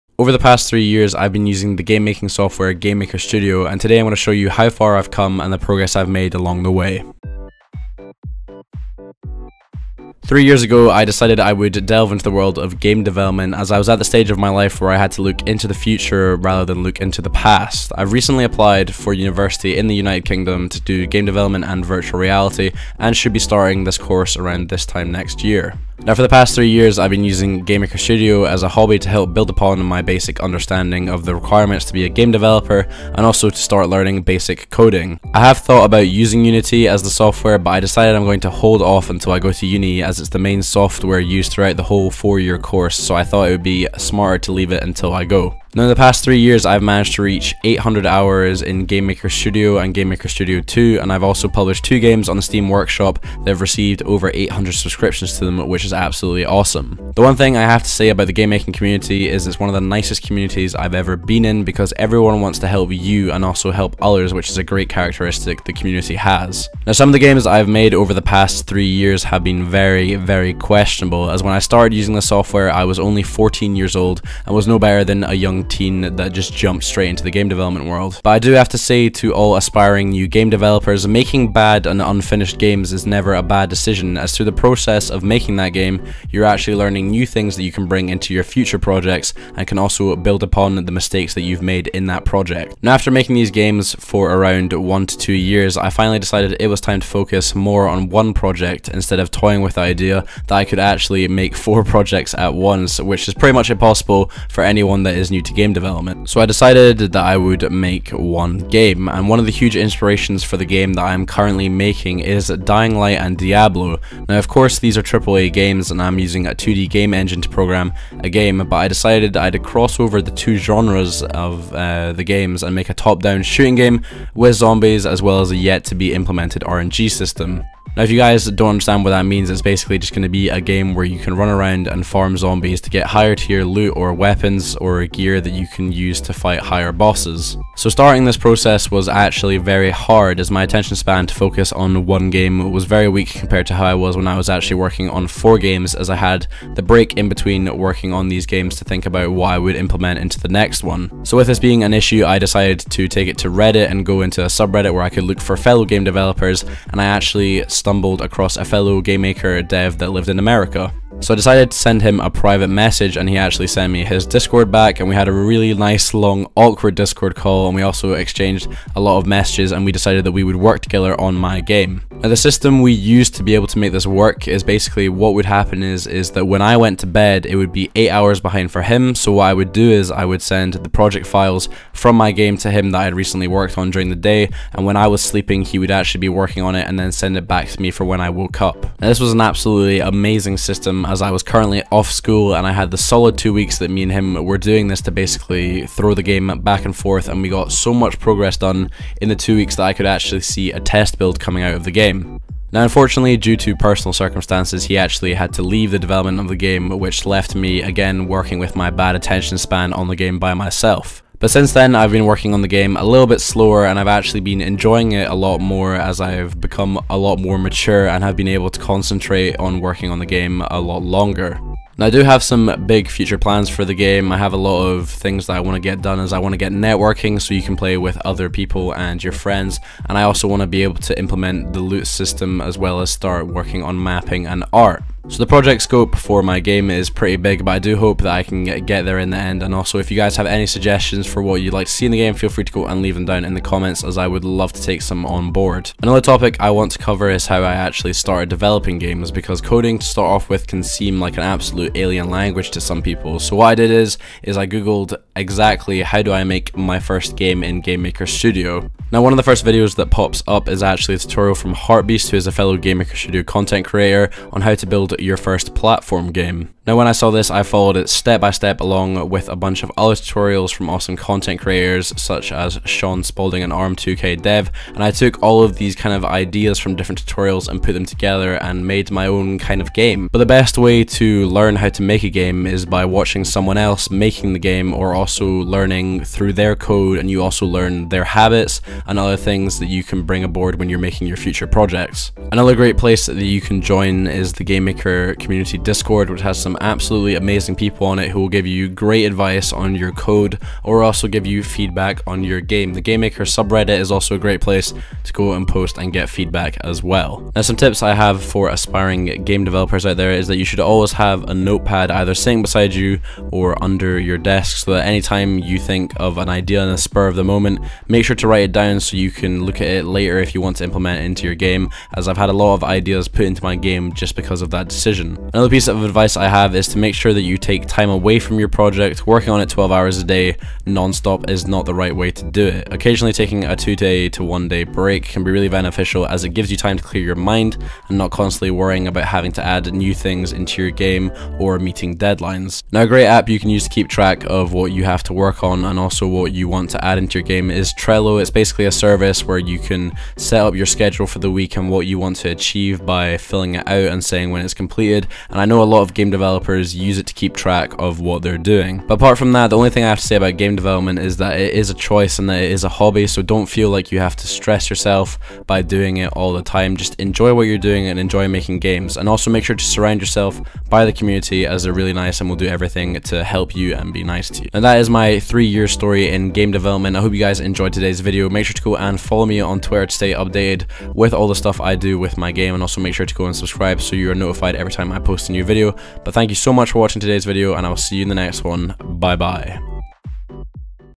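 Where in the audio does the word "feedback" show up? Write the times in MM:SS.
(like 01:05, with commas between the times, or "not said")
05:01, 05:06.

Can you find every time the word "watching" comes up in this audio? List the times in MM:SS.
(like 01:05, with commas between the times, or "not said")
04:43, 06:26.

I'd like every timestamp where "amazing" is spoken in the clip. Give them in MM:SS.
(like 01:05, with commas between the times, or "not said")
03:10, 04:57.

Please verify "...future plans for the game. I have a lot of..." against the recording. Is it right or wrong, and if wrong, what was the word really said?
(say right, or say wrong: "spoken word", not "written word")
right.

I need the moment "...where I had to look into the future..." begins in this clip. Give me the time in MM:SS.
00:14.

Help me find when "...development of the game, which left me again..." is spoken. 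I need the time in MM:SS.
03:25.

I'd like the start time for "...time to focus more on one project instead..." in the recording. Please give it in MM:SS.
01:36.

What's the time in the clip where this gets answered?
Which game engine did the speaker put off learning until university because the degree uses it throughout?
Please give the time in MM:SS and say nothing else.
00:36.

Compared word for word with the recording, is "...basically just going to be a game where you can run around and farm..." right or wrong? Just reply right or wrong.
right.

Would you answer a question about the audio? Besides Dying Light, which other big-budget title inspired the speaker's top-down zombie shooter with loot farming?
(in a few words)
Diablo.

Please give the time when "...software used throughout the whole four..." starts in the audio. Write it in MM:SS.
00:40.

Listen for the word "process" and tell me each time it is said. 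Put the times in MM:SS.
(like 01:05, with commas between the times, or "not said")
01:24, 02:18.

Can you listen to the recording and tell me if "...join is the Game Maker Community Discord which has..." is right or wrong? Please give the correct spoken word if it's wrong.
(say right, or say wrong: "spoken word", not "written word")
right.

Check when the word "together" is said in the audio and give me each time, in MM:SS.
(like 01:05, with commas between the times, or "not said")
02:50, 04:38.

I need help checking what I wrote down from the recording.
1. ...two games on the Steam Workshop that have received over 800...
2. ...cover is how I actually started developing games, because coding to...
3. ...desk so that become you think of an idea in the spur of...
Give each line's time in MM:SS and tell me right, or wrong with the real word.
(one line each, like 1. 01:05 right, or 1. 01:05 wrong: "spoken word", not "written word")
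1. 00:51 right
2. 04:06 right
3. 05:14 wrong: "anytime", not "become".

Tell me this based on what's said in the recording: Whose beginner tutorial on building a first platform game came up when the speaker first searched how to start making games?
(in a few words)
Heartbeast.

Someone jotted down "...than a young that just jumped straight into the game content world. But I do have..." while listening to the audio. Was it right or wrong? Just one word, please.
wrong.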